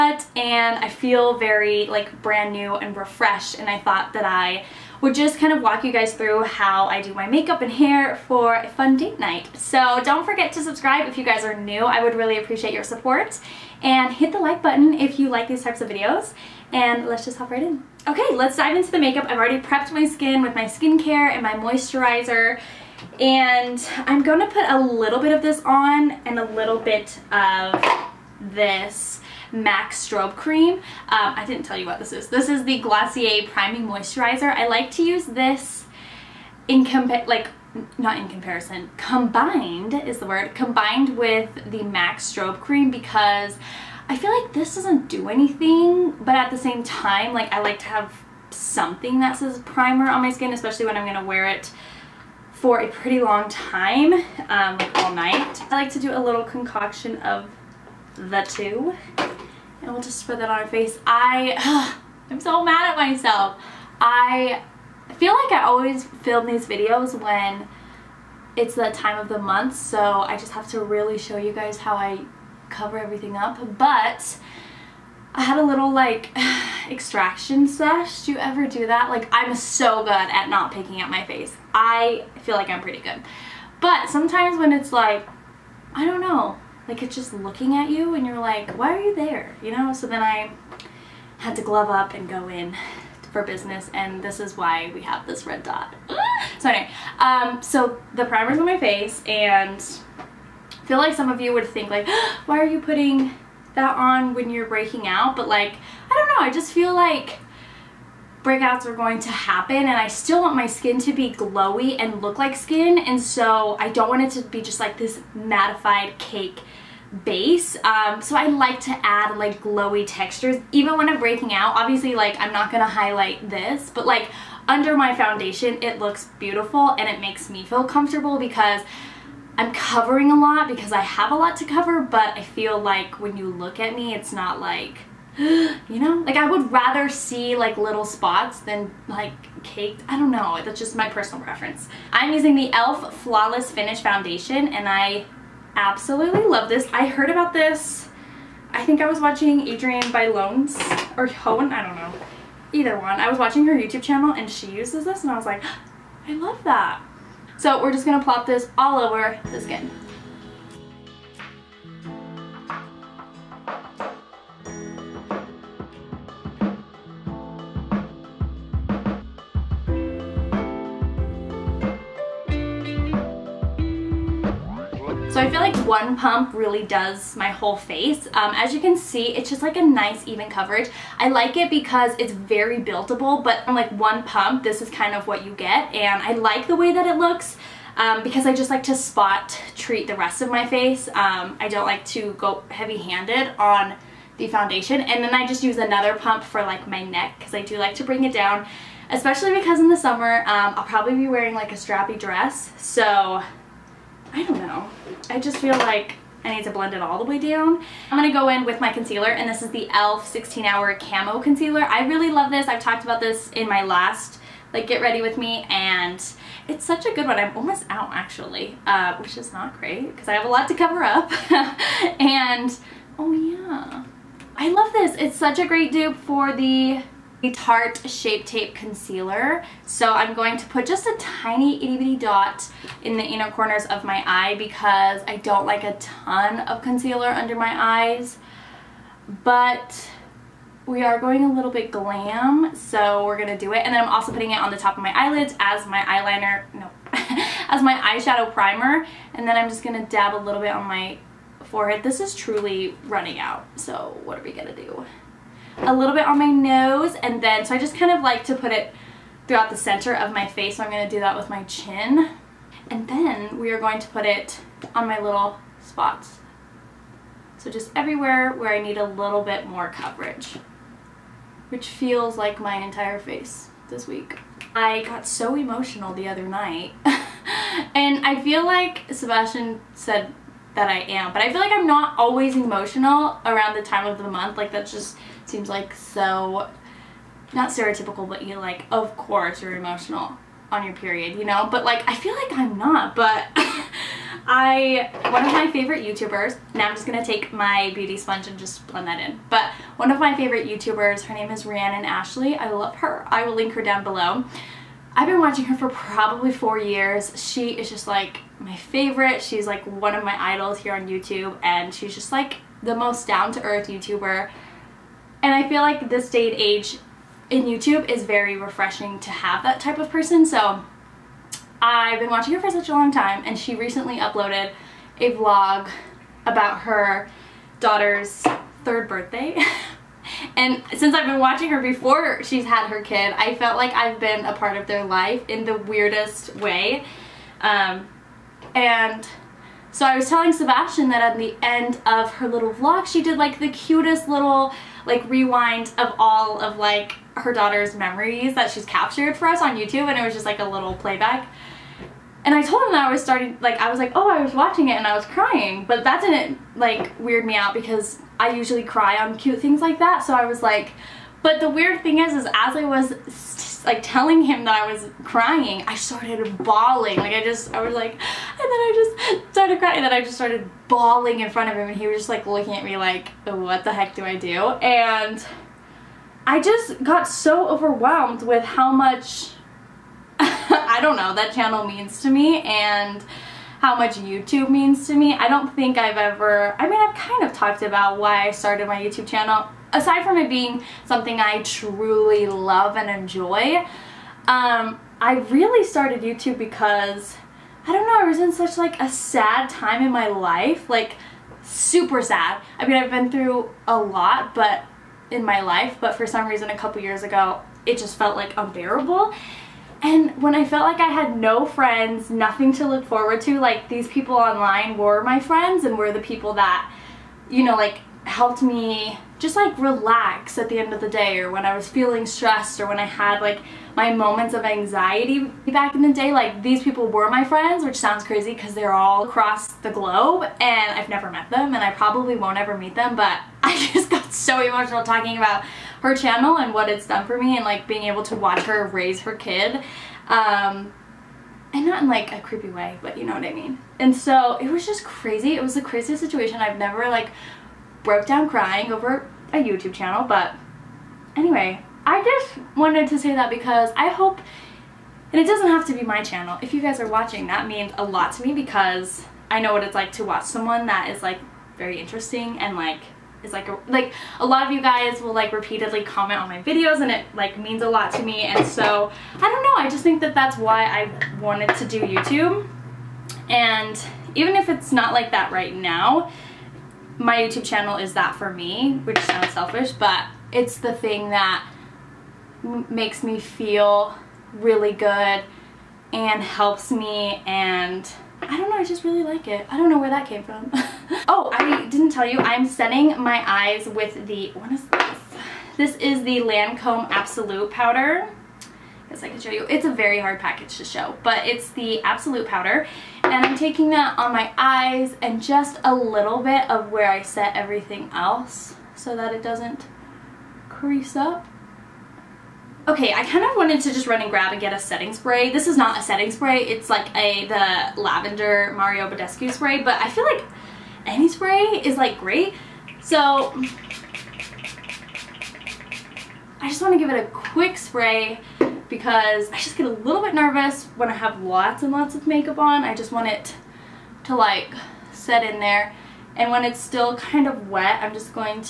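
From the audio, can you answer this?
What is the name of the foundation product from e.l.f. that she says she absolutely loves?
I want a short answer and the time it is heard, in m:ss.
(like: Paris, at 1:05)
Flawless Finish, at 2:23.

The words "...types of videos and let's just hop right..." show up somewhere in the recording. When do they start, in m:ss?
0:15.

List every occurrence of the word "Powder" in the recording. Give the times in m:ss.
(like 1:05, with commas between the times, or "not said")
8:17, 8:22.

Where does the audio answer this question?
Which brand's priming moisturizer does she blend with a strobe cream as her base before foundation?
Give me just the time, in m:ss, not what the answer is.
0:32.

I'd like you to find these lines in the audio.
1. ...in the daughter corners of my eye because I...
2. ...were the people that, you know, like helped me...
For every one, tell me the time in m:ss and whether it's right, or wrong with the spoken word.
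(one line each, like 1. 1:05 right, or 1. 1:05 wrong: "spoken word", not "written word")
1. 3:53 wrong: "inner", not "daughter"
2. 6:55 right.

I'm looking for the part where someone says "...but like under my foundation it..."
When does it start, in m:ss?
2:03.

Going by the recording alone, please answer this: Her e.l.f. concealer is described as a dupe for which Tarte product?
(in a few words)
Shape Tape Concealer.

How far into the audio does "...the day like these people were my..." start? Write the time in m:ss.
7:06.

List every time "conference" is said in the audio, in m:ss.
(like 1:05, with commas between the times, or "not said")
not said.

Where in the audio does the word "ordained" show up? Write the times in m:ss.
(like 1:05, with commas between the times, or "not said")
not said.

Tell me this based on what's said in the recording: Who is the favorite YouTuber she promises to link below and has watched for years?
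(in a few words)
Rhiannon Ashlee.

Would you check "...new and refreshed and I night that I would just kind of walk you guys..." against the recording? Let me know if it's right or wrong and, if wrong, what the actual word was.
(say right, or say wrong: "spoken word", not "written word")
wrong: "thought", not "night".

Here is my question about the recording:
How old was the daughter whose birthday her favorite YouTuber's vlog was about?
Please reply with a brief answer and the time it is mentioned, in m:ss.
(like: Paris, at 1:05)
3, at 5:28.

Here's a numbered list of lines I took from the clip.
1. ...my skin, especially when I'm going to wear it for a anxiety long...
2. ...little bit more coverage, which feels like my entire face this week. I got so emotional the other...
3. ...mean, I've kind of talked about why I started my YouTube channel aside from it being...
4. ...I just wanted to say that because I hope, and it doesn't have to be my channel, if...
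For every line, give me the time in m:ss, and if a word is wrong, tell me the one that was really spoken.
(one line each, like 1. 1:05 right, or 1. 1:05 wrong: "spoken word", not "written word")
1. 0:50 wrong: "pretty", not "anxiety"
2. 4:29 right
3. 6:26 right
4. 7:32 right.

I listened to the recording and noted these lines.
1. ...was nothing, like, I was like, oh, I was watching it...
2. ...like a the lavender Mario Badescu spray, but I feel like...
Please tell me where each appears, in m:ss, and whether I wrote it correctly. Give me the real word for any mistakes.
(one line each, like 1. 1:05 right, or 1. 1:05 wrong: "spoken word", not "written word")
1. 5:53 wrong: "starting", not "nothing"
2. 8:36 right.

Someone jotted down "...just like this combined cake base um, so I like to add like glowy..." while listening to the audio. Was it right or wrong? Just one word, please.
wrong.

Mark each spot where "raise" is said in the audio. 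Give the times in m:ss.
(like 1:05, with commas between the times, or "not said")
7:18.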